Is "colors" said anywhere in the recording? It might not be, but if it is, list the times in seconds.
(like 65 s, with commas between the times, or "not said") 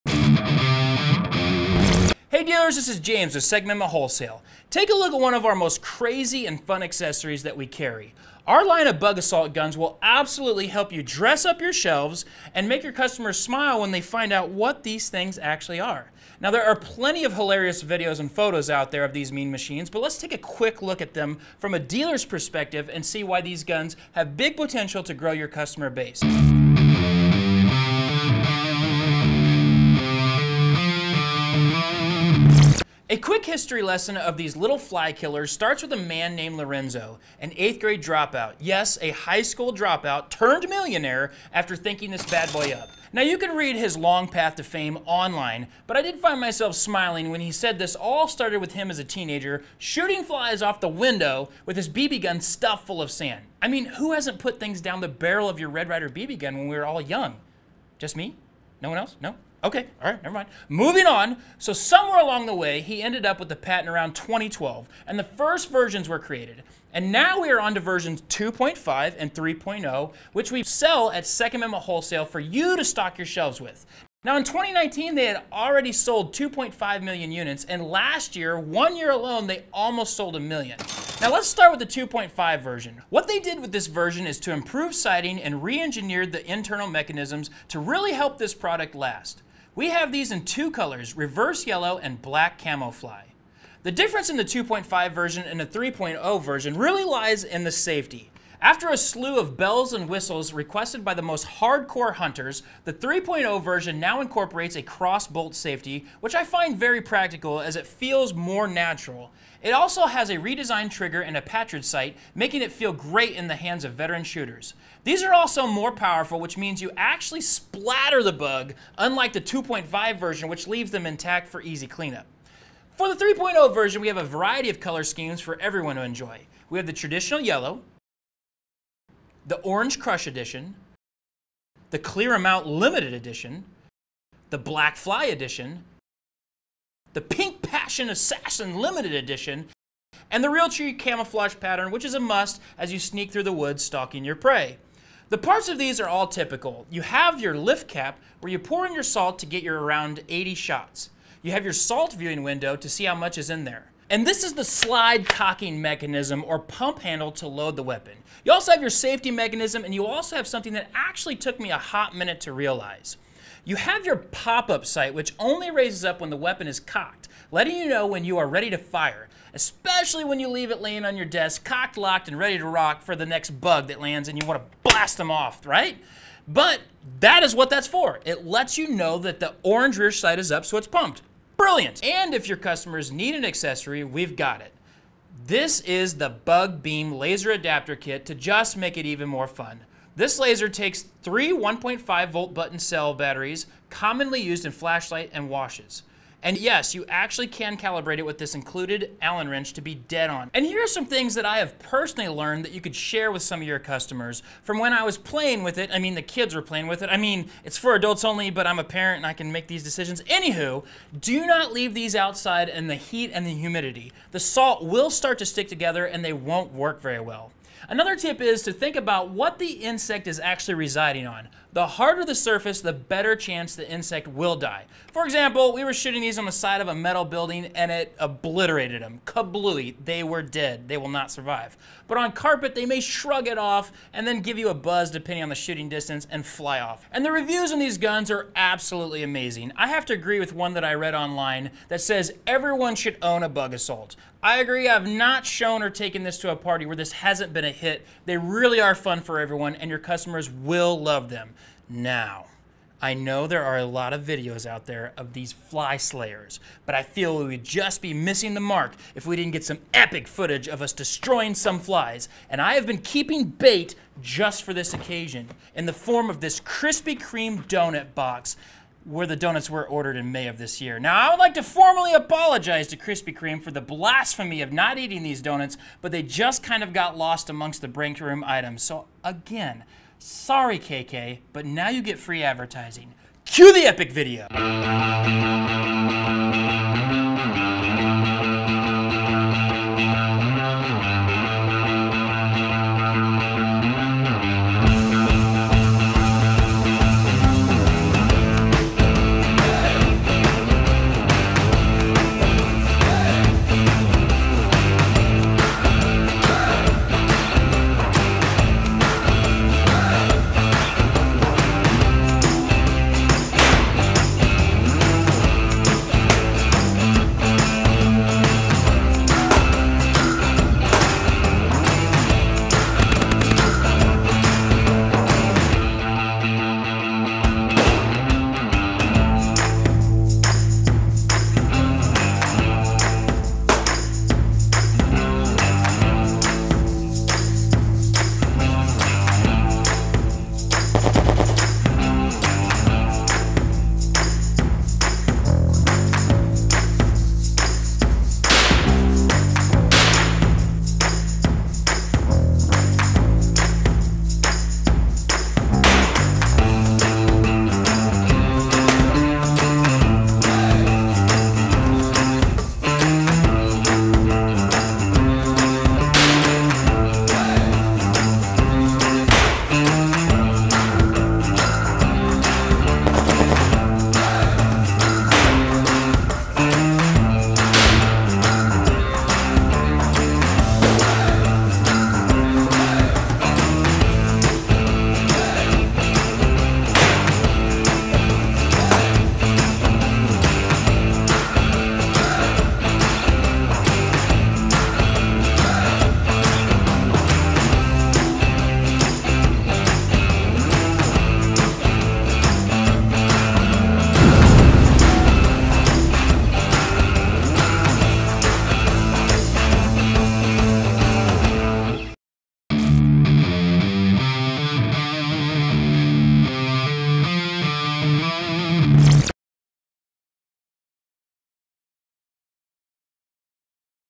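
90 s, 124 s.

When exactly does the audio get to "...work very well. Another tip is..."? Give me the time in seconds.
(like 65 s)
216 s.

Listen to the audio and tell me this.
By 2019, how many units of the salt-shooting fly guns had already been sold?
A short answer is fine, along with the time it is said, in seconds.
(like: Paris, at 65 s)
2.5 million, at 76 s.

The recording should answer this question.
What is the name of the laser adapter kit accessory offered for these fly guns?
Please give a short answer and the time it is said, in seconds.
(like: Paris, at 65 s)
Bug Beam, at 186 s.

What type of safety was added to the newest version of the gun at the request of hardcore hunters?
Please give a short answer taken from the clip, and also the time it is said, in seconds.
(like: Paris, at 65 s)
cross-bolt safety, at 104 s.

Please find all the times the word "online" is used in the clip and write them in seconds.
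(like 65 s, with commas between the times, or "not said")
45 s, 241 s.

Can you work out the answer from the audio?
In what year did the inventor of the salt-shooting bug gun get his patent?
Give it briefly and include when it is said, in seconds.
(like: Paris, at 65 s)
2012, at 64 s.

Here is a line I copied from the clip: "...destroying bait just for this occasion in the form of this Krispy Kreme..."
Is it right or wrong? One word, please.
wrong.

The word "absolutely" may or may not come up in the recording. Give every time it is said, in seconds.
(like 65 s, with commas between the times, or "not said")
10 s, 238 s.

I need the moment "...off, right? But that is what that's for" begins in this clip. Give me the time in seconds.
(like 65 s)
175 s.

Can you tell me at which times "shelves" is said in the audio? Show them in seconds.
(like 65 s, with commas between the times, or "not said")
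11 s, 73 s.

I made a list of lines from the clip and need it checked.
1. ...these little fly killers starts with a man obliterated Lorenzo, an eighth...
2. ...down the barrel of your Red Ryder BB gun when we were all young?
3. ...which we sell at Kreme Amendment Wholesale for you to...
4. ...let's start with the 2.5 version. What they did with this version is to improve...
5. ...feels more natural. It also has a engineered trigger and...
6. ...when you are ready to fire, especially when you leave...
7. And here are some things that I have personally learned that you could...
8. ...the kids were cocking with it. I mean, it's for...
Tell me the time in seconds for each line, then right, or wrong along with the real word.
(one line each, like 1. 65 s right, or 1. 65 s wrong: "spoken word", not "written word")
1. 34 s wrong: "named", not "obliterated"
2. 54 s right
3. 70 s wrong: "Second", not "Kreme"
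4. 81 s right
5. 107 s wrong: "redesigned", not "engineered"
6. 168 s right
7. 200 s right
8. 206 s wrong: "playing", not "cocking".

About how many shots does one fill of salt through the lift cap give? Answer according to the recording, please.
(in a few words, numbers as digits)
80.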